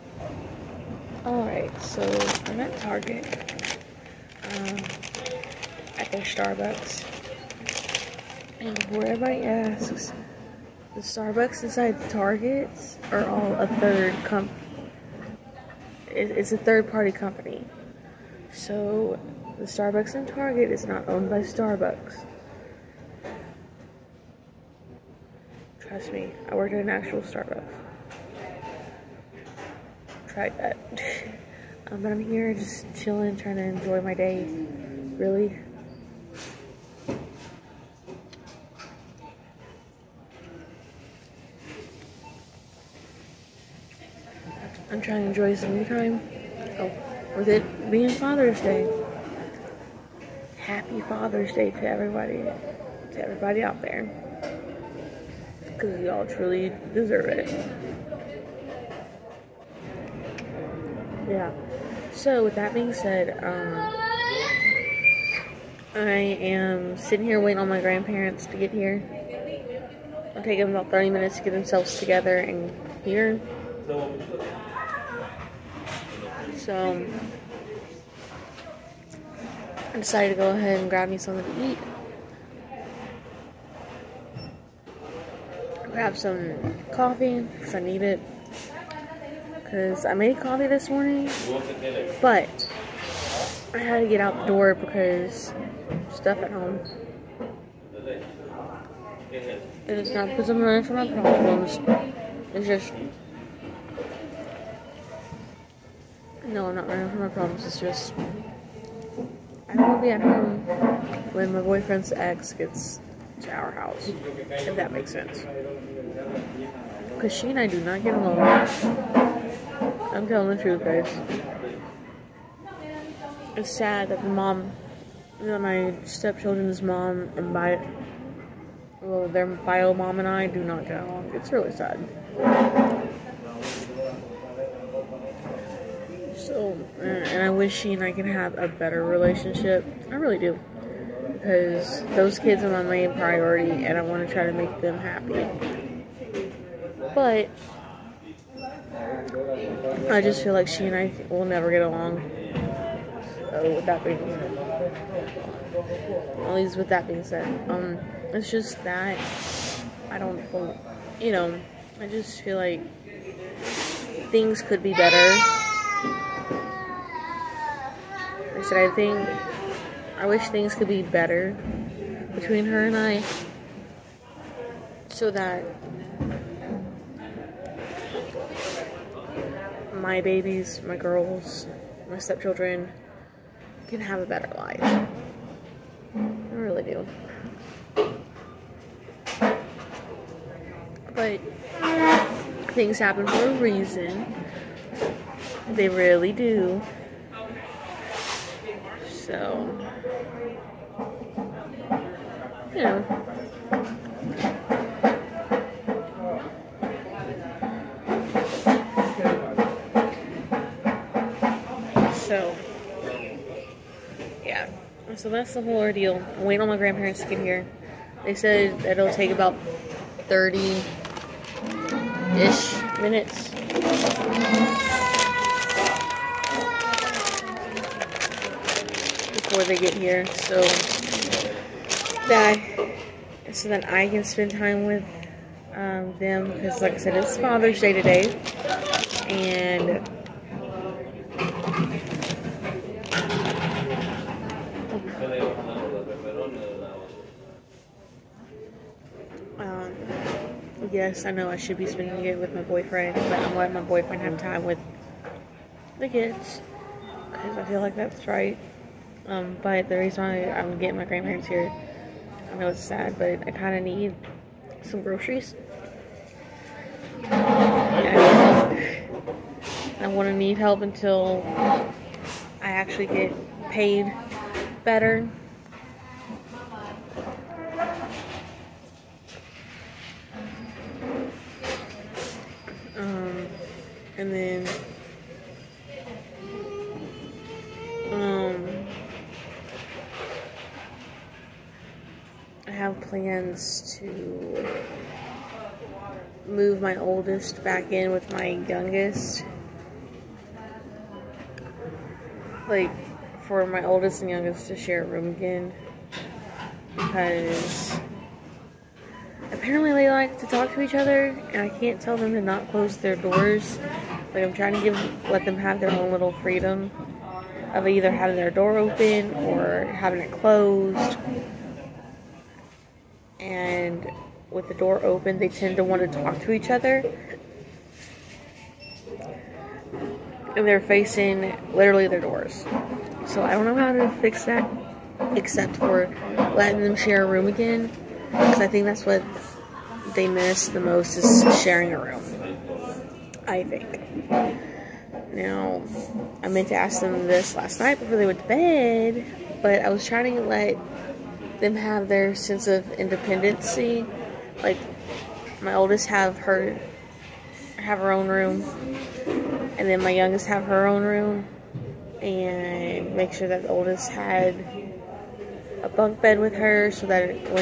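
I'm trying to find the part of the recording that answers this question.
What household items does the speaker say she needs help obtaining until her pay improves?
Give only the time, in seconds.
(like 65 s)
265 s.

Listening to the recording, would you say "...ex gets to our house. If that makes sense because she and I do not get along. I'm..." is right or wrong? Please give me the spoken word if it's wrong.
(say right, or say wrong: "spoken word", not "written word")
right.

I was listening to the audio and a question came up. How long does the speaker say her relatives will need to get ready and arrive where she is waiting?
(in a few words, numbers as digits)
30 minutes.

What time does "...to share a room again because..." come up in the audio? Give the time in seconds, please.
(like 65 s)
304 s.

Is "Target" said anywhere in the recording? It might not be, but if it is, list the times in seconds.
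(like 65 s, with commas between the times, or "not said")
2 s, 12 s, 20 s.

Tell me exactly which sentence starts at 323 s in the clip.
And with the door open, they tend to want to talk to each other.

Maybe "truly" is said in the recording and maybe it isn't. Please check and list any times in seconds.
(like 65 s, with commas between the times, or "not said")
56 s.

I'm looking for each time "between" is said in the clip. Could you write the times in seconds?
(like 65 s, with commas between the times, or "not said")
172 s.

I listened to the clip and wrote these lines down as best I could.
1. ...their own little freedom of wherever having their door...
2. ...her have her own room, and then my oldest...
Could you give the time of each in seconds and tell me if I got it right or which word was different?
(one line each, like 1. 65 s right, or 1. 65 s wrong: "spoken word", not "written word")
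1. 315 s wrong: "either", not "wherever"
2. 356 s wrong: "youngest", not "oldest".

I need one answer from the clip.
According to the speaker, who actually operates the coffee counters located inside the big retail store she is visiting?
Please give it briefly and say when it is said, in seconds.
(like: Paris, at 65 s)
A third party company, at 16 s.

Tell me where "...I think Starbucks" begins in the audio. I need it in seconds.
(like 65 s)
5 s.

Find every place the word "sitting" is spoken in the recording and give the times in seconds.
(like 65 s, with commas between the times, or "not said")
66 s.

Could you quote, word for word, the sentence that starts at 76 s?
So, I decided to go ahead and grab me something to eat.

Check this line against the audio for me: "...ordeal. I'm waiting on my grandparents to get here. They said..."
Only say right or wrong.
right.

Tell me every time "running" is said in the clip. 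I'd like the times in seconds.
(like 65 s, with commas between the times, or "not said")
100 s, 106 s.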